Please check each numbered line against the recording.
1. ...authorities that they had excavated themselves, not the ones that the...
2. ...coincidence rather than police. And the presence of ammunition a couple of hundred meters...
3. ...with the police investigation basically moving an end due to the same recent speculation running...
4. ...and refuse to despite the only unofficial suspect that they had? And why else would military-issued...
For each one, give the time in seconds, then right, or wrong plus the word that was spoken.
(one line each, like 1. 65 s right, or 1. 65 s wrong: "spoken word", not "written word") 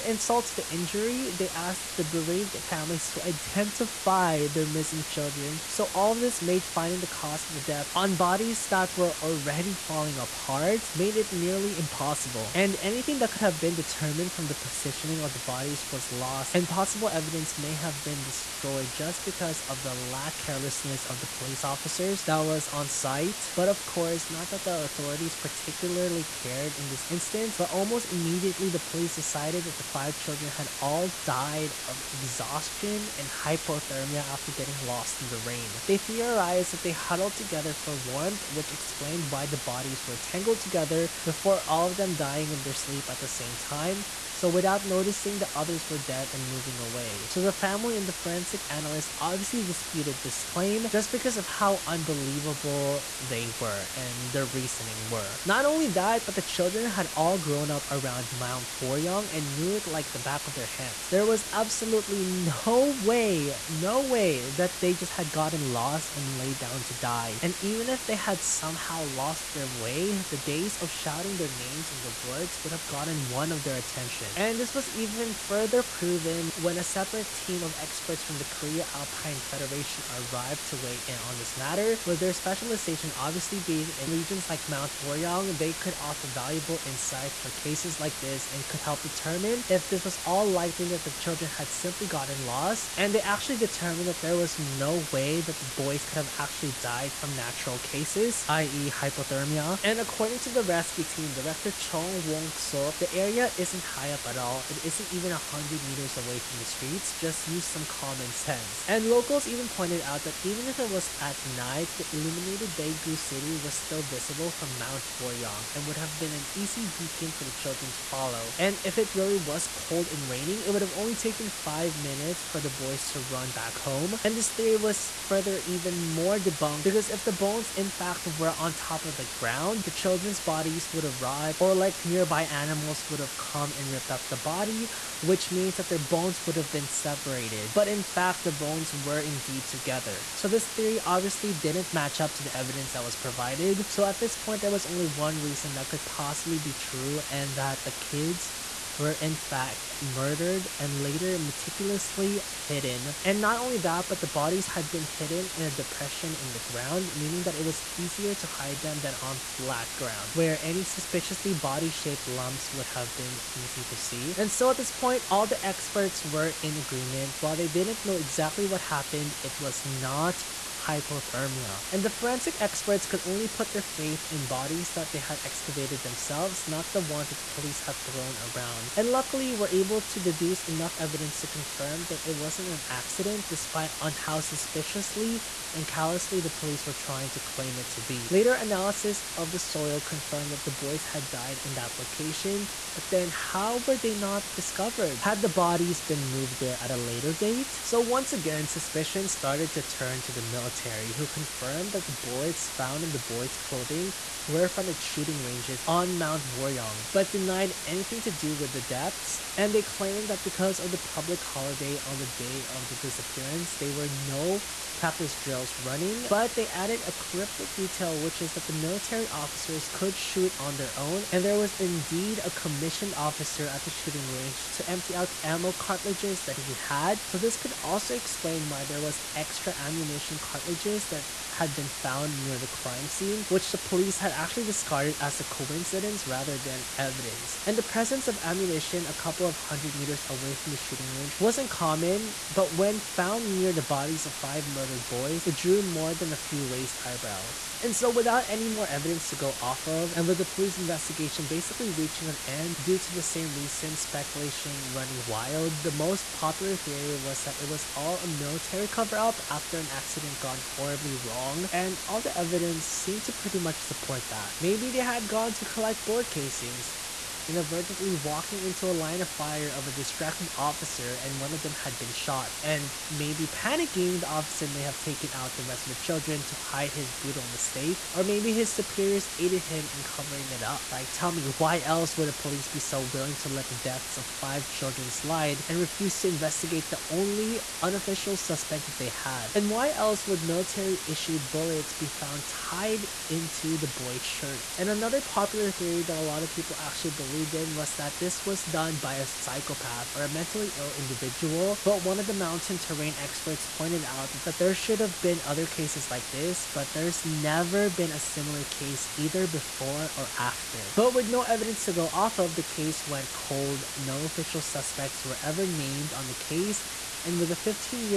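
1. 174 s wrong: "bodies", not "authorities"
2. 235 s wrong: "evidence", not "police"
3. 250 s wrong: "reaching", not "moving"
4. 285 s wrong: "investigate", not "despite".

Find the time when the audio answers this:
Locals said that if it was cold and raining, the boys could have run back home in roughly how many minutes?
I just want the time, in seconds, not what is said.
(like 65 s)
121 s.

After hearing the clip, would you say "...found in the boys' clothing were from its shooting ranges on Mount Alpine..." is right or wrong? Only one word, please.
wrong.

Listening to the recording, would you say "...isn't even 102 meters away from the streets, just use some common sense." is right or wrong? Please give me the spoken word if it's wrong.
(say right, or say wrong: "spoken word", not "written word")
wrong: "100", not "102".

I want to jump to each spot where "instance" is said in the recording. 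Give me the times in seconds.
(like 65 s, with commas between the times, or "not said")
27 s.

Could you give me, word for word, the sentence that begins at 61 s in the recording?
There was absolutely no way, no way that they just had gotten lost and laid down to die.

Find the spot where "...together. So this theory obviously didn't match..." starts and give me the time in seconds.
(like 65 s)
139 s.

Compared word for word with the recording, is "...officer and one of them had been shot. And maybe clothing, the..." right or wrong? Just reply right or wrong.
wrong.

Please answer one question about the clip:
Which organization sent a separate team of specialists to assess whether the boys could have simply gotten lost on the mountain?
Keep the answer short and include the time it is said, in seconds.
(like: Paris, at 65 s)
Korea Alpine Federation, at 78 s.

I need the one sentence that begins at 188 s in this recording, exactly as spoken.
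Later analysis of the soil confirmed that the boys had died in that location, but then how were they not discovered?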